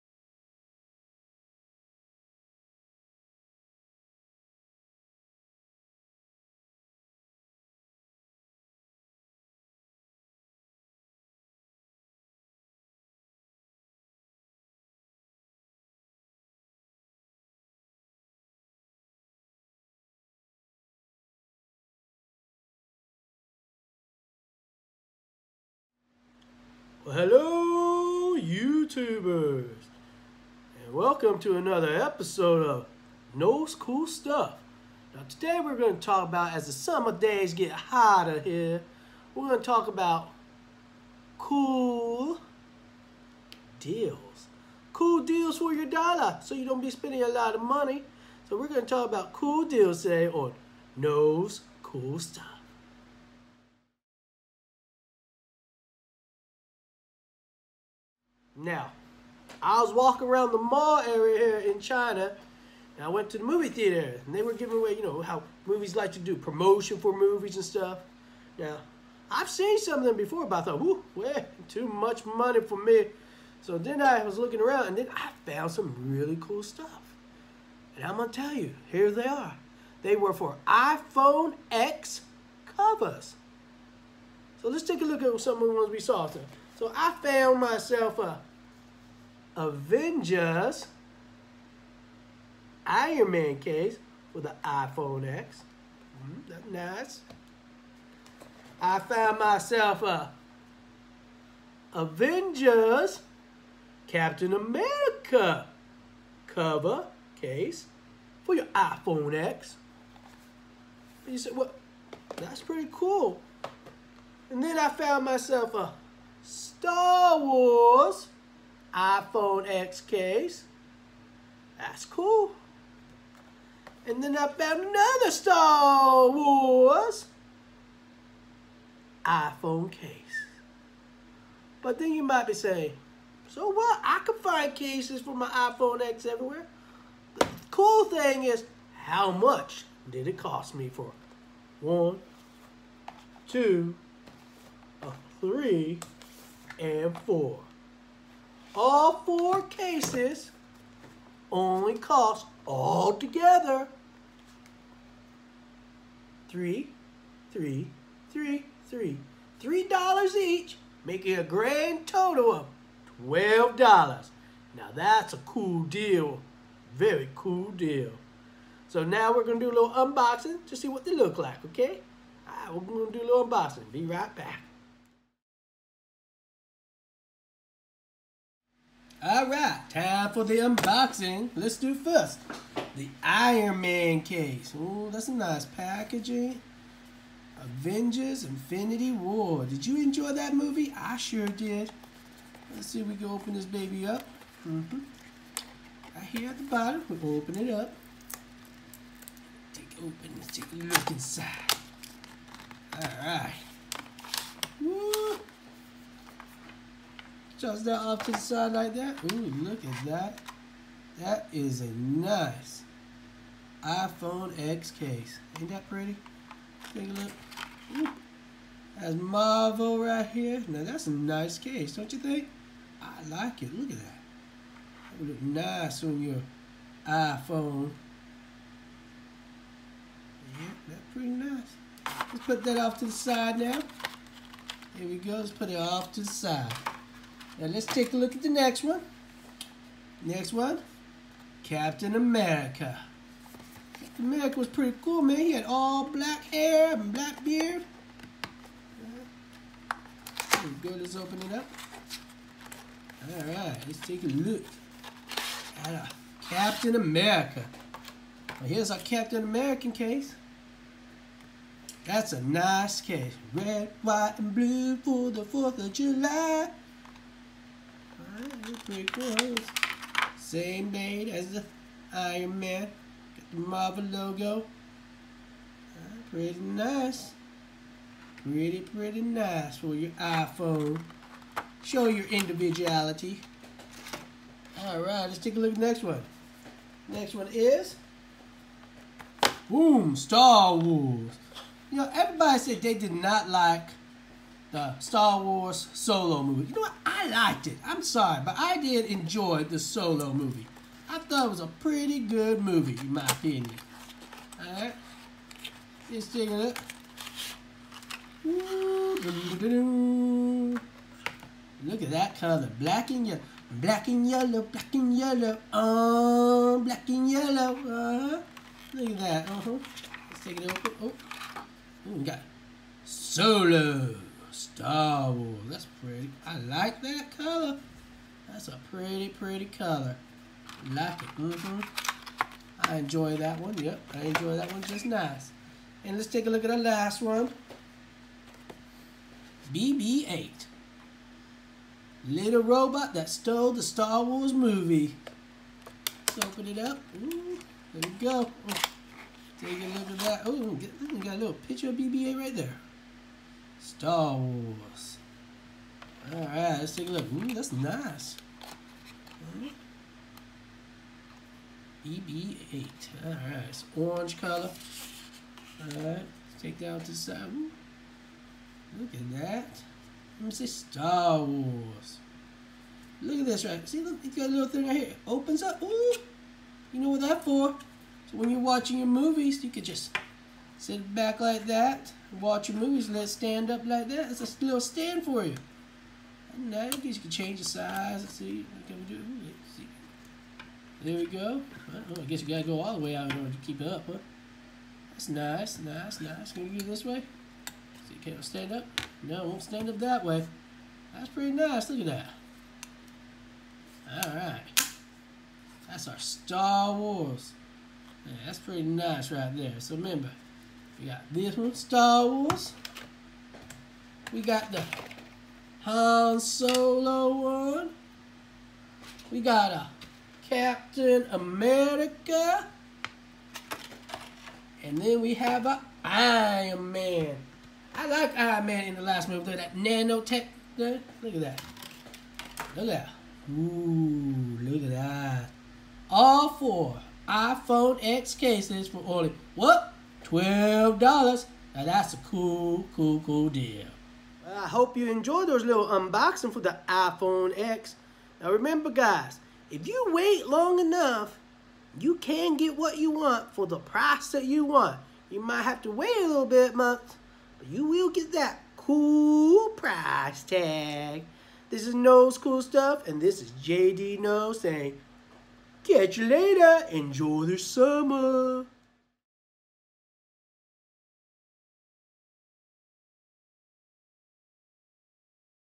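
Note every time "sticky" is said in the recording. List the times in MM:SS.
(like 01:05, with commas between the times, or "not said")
not said.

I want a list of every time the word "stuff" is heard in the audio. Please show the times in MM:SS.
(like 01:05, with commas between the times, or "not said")
00:34, 00:52, 01:07, 01:16, 07:42.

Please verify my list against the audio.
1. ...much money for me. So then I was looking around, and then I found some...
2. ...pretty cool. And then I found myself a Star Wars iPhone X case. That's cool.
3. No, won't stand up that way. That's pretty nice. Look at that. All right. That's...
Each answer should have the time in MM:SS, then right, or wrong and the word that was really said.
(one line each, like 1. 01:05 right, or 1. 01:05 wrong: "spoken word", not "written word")
1. 01:11 right
2. 01:52 right
3. 06:39 right.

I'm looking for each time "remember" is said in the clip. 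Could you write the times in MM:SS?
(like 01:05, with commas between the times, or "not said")
06:49, 07:28.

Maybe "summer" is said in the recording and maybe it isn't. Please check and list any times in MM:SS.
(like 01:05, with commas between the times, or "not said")
00:36, 07:47.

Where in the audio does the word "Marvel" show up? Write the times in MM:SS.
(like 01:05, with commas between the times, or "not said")
03:39, 04:33.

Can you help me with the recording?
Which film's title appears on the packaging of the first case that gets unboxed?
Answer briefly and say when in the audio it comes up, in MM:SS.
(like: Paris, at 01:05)
Avengers Infinity War, at 03:07.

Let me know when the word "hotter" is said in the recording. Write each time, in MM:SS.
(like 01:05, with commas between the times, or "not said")
00:37.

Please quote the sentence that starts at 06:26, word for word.
guess you can change the size.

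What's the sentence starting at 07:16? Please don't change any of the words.
All four iPhone X cases for only, what?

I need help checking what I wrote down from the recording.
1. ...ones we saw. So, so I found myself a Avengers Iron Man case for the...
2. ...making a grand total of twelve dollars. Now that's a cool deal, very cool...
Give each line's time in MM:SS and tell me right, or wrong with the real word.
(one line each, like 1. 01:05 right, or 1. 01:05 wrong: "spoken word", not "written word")
1. 01:25 right
2. 02:41 right.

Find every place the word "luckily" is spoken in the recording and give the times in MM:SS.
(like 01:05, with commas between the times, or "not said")
not said.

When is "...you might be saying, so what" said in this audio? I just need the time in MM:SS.
02:12.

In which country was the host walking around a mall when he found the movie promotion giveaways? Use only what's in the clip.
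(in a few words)
China.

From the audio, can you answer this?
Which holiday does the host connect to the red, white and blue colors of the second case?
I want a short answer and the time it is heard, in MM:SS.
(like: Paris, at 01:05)
4th of July, at 04:25.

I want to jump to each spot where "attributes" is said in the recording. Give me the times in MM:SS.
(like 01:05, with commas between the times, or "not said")
not said.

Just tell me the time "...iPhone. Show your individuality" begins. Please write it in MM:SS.
04:40.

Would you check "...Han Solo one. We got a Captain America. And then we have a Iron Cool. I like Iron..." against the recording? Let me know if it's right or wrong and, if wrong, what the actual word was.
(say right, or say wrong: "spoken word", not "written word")
wrong: "Man", not "Cool".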